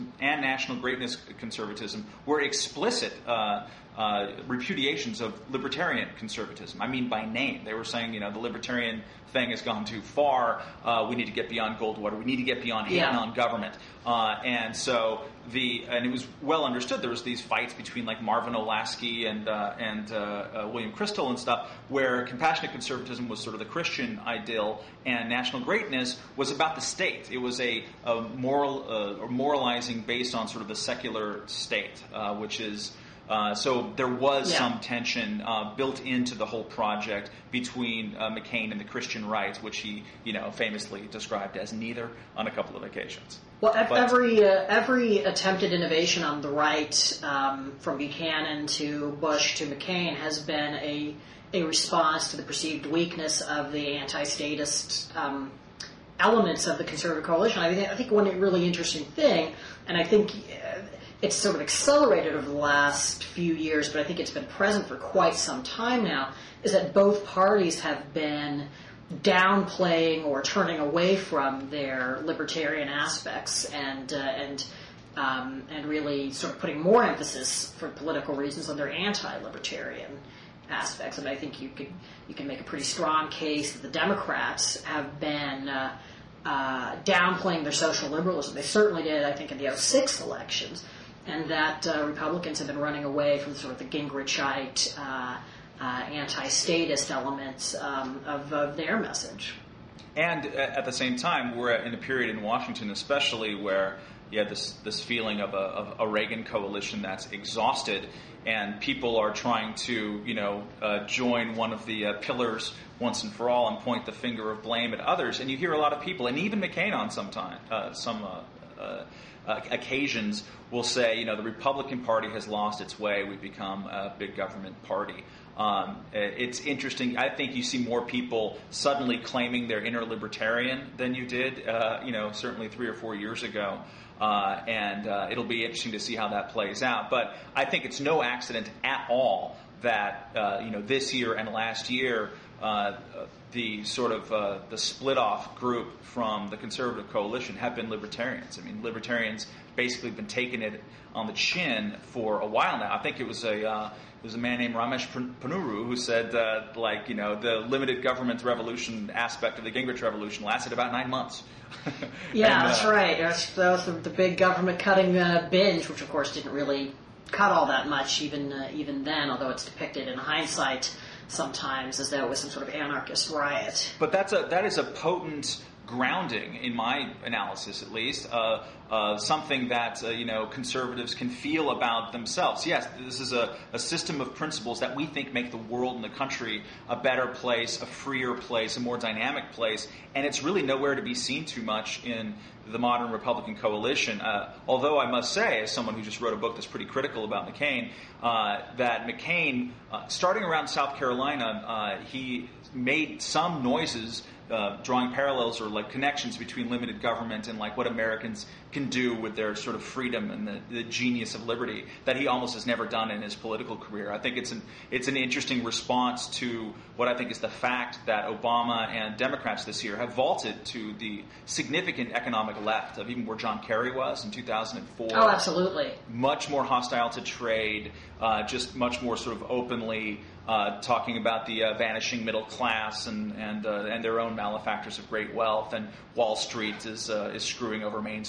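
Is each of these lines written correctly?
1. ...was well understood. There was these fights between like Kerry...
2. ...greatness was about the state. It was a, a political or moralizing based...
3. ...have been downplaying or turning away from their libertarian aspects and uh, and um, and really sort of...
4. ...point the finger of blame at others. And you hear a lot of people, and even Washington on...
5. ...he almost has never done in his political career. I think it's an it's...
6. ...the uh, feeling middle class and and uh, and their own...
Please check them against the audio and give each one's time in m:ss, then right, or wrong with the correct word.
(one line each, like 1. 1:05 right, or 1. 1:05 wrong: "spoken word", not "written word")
1. 0:16 wrong: "Marvin", not "Kerry"
2. 0:25 wrong: "moral", not "political"
3. 1:07 right
4. 1:53 wrong: "McCain", not "Washington"
5. 3:32 right
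6. 3:51 wrong: "vanishing", not "feeling".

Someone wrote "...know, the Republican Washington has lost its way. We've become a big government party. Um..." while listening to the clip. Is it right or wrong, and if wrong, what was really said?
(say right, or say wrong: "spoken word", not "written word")
wrong: "Party", not "Washington".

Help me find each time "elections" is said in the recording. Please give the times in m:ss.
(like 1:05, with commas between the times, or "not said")
1:30.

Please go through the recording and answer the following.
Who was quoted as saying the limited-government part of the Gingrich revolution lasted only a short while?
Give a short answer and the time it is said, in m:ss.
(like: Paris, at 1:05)
Ramesh Ponnuru, at 2:34.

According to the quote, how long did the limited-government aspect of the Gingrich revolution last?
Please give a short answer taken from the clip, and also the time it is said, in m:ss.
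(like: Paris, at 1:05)
About nine months, at 2:40.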